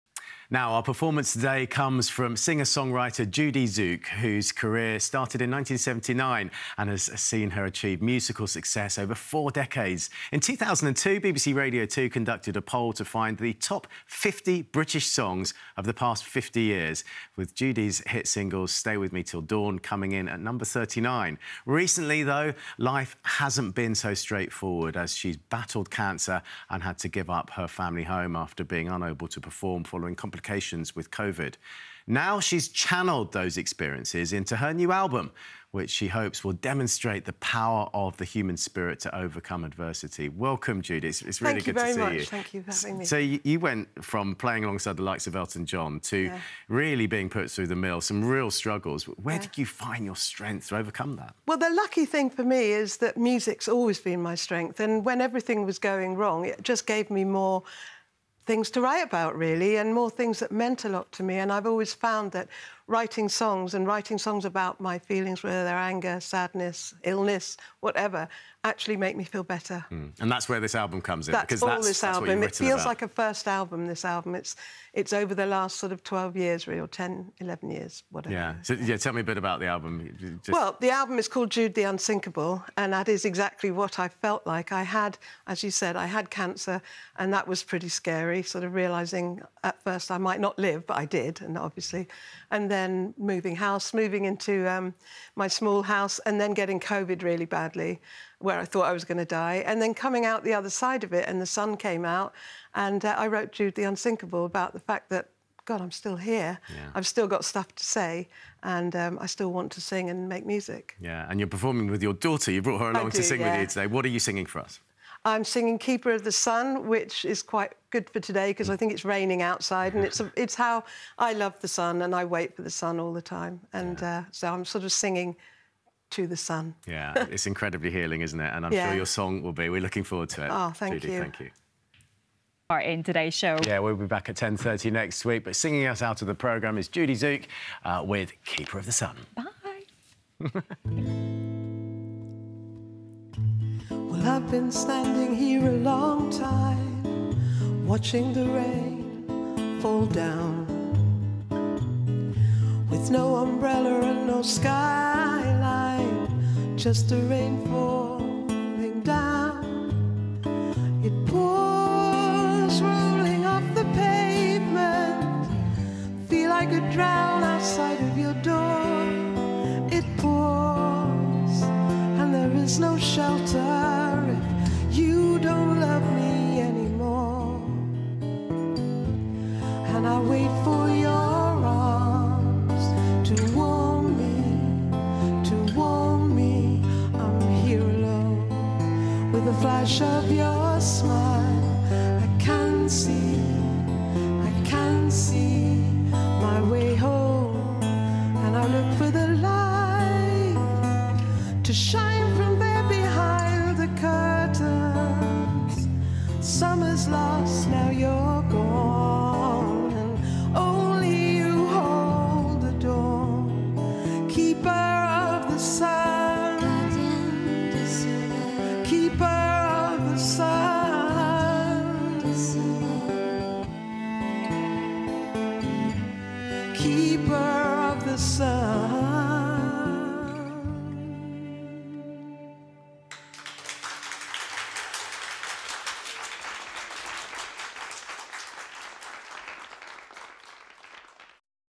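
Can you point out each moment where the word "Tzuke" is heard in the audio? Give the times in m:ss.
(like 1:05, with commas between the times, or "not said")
0:03, 2:17.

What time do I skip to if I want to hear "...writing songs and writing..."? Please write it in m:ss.
1:02.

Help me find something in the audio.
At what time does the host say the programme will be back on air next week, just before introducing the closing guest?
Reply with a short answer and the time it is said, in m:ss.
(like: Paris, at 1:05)
10.30, at 2:14.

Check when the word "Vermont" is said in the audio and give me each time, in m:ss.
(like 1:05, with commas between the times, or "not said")
not said.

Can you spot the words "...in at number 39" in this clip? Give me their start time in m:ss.
0:20.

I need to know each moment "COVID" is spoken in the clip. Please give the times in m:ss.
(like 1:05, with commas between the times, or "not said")
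0:31, 1:36.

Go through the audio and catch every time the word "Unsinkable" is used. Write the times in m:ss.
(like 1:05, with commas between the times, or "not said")
1:21, 1:43.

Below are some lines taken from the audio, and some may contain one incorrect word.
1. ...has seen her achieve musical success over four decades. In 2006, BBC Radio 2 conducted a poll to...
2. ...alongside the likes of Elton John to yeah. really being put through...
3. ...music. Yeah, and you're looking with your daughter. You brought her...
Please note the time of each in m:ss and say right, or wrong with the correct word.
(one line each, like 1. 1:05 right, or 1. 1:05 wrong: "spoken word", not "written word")
1. 0:06 wrong: "2002", not "2006"
2. 0:44 right
3. 1:50 wrong: "performing", not "looking".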